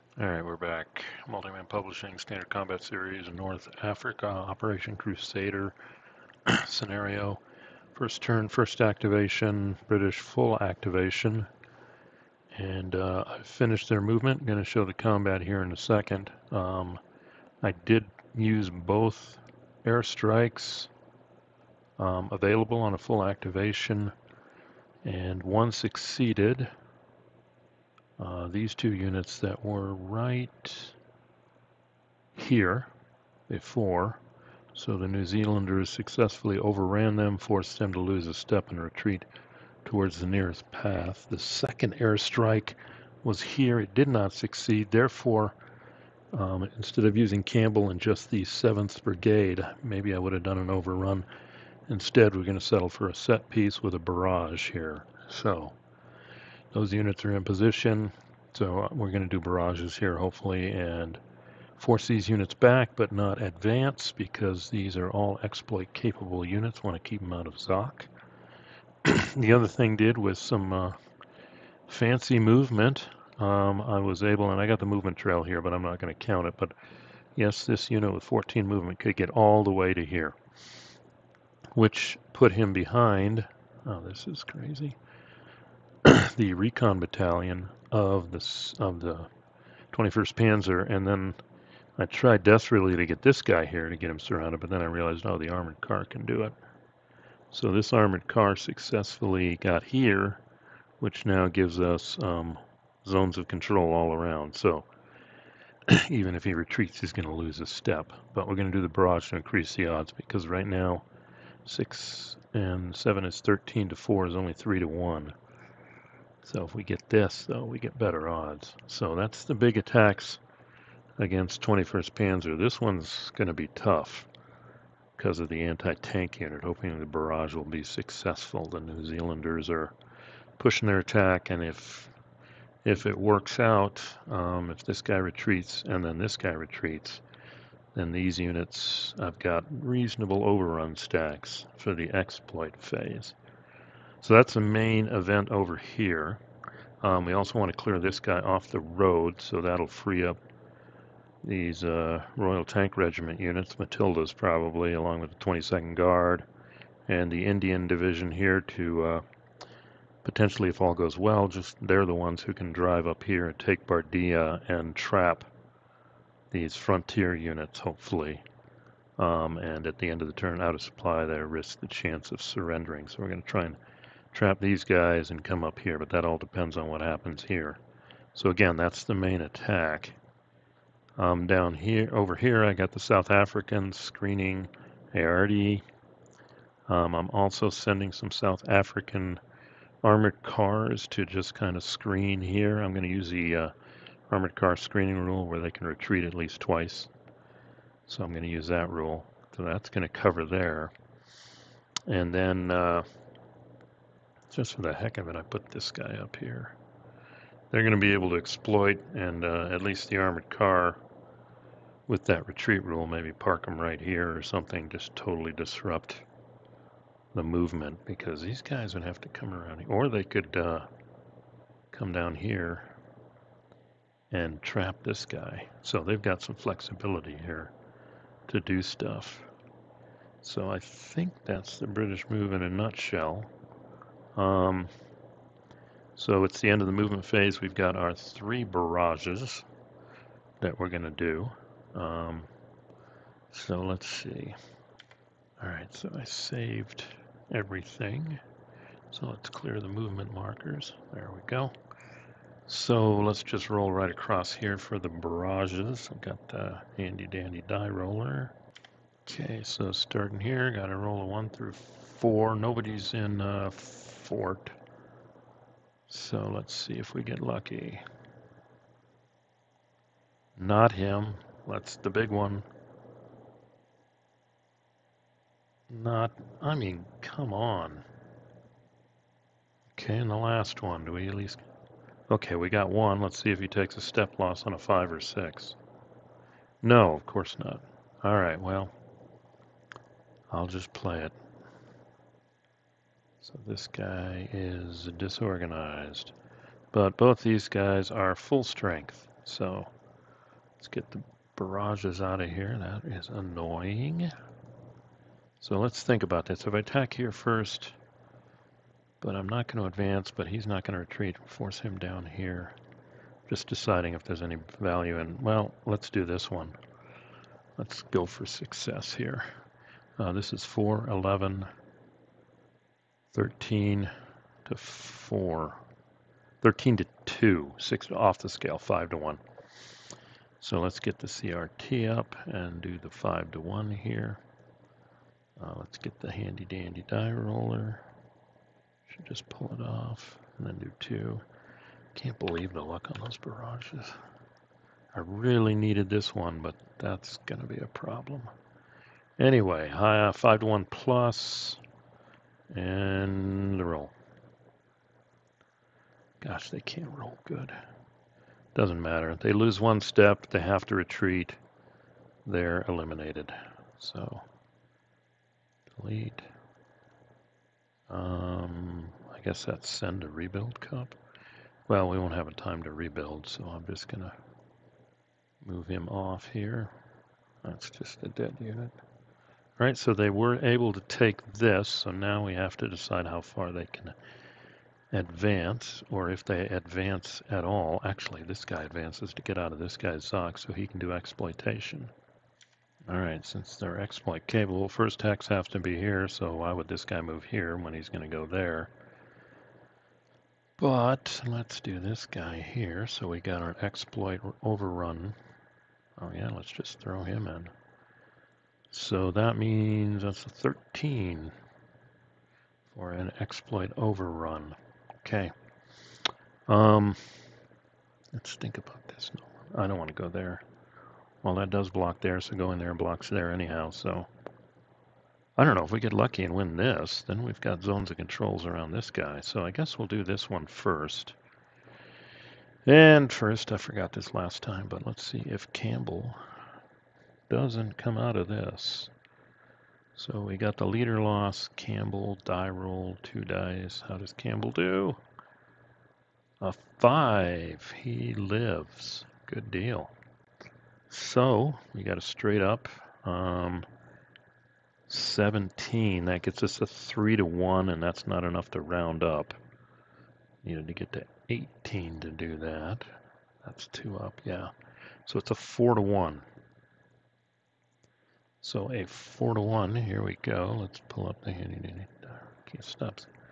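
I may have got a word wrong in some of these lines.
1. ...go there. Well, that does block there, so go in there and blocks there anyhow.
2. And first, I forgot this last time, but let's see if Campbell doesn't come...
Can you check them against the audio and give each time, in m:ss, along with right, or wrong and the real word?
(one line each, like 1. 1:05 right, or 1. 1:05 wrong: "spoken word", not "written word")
1. 7:00 right
2. 7:12 right.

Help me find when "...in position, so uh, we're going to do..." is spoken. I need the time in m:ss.
0:57.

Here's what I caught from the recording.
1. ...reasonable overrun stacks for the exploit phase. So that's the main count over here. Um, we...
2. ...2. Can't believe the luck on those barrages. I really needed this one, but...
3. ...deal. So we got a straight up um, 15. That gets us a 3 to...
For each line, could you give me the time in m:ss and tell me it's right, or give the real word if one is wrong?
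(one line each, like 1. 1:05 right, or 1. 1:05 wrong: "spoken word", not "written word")
1. 2:19 wrong: "event", not "count"
2. 5:40 right
3. 7:29 wrong: "17", not "15".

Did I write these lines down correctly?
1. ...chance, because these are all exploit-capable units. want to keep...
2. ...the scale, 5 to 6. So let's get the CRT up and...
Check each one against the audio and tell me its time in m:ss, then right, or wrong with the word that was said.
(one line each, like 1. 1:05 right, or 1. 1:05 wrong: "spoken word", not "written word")
1. 1:03 wrong: "advance", not "chance"
2. 5:28 wrong: "1", not "6".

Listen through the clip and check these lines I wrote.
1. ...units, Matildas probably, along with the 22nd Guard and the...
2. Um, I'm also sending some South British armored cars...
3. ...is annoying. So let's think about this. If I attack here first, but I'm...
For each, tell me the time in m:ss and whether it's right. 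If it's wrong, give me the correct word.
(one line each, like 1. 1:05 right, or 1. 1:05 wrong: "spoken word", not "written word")
1. 2:33 right
2. 3:06 wrong: "African", not "British"
3. 5:03 right.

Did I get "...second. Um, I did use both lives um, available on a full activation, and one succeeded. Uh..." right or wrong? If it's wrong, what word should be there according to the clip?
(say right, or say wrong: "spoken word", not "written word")
wrong: "airstrikes", not "lives".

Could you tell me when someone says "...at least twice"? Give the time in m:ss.
3:16.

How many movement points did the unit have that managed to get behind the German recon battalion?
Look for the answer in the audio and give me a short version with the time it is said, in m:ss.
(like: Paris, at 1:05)
14, at 1:18.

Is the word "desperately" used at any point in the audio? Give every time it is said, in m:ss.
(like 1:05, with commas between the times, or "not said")
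1:32.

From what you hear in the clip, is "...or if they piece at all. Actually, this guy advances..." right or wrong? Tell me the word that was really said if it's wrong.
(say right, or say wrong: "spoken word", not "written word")
wrong: "advance", not "piece".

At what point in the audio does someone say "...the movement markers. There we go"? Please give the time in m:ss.
4:09.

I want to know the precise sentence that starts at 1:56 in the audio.
So if we get this, though, we get better odds.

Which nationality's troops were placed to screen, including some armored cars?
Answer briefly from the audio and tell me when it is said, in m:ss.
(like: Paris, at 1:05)
South Africans, at 3:02.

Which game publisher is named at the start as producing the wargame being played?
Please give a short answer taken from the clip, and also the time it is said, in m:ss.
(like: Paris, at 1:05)
Multiman Publishing, at 0:01.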